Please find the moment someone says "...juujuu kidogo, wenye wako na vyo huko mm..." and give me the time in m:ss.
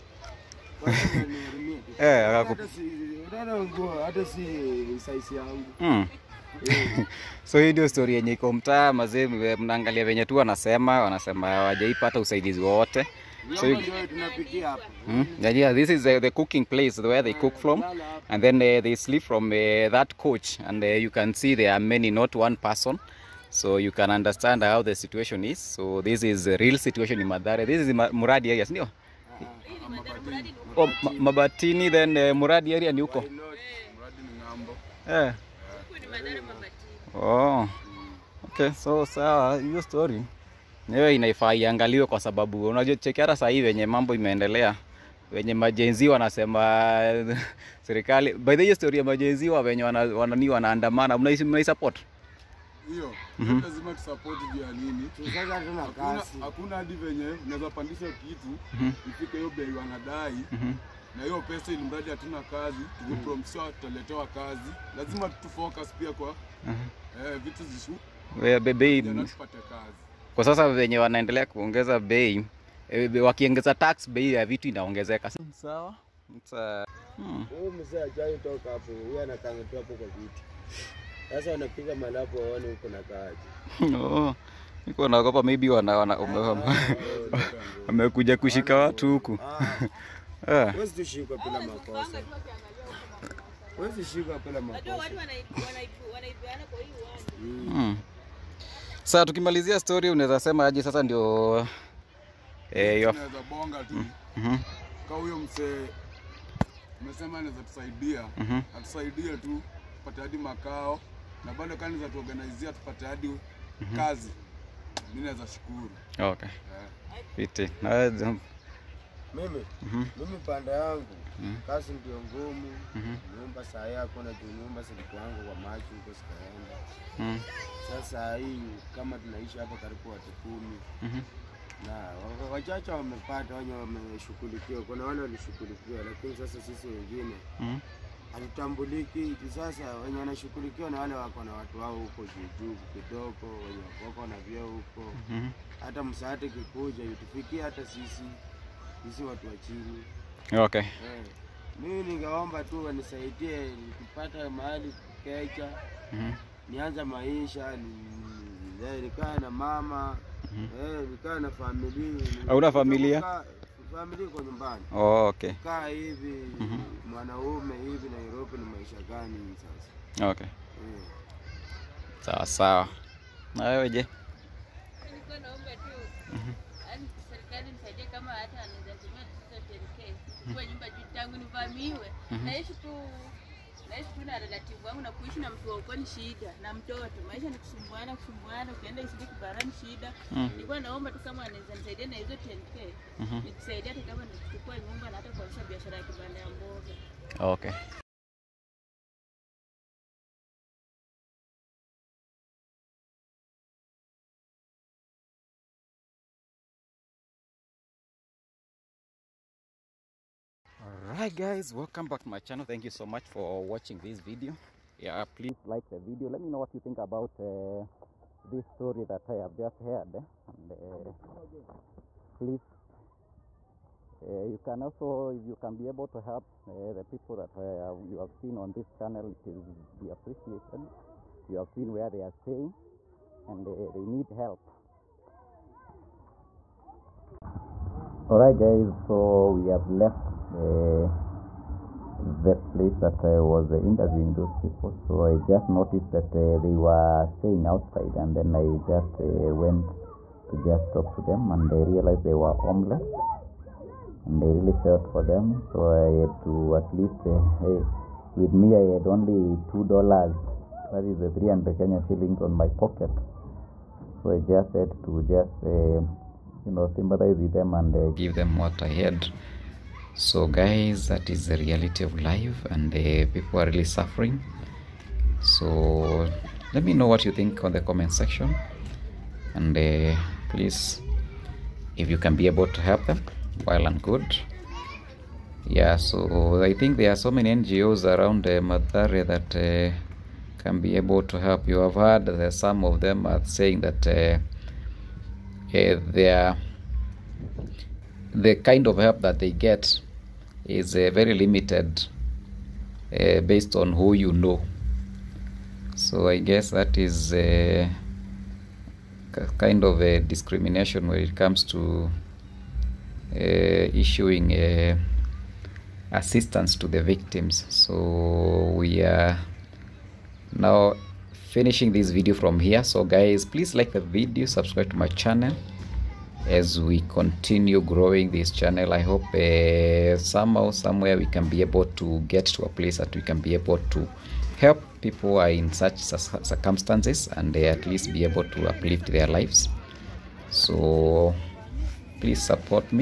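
2:22.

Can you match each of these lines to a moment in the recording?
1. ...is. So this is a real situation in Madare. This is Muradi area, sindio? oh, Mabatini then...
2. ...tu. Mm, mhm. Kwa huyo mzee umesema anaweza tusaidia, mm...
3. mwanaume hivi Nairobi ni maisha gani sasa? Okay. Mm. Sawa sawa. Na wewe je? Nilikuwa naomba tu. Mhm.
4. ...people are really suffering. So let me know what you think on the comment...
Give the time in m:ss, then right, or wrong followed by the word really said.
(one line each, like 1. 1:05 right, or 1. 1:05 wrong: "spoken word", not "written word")
1. 0:25 right
2. 1:43 right
3. 2:47 right
4. 4:33 right.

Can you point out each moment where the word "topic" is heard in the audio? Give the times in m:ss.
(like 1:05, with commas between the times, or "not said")
not said.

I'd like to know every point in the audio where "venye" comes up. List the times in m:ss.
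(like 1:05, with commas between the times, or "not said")
0:10, 0:56.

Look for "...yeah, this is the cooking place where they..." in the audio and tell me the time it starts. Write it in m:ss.
0:15.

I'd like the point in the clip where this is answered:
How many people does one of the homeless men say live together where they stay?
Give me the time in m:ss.
2:09.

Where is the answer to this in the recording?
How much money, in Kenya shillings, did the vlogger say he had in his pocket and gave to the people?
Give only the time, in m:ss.
4:21.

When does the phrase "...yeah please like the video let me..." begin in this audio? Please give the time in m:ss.
3:35.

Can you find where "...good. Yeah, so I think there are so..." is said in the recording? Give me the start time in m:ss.
4:44.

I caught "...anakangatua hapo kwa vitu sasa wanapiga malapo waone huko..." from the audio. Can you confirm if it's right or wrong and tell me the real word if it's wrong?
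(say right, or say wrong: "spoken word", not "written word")
right.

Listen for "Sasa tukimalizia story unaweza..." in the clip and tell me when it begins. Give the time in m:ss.
1:39.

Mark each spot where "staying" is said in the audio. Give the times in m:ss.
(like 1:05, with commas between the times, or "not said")
3:52, 4:07.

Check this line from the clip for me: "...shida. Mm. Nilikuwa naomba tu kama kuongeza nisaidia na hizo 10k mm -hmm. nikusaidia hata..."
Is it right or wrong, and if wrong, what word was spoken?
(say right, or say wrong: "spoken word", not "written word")
wrong: "anaweza", not "kuongeza".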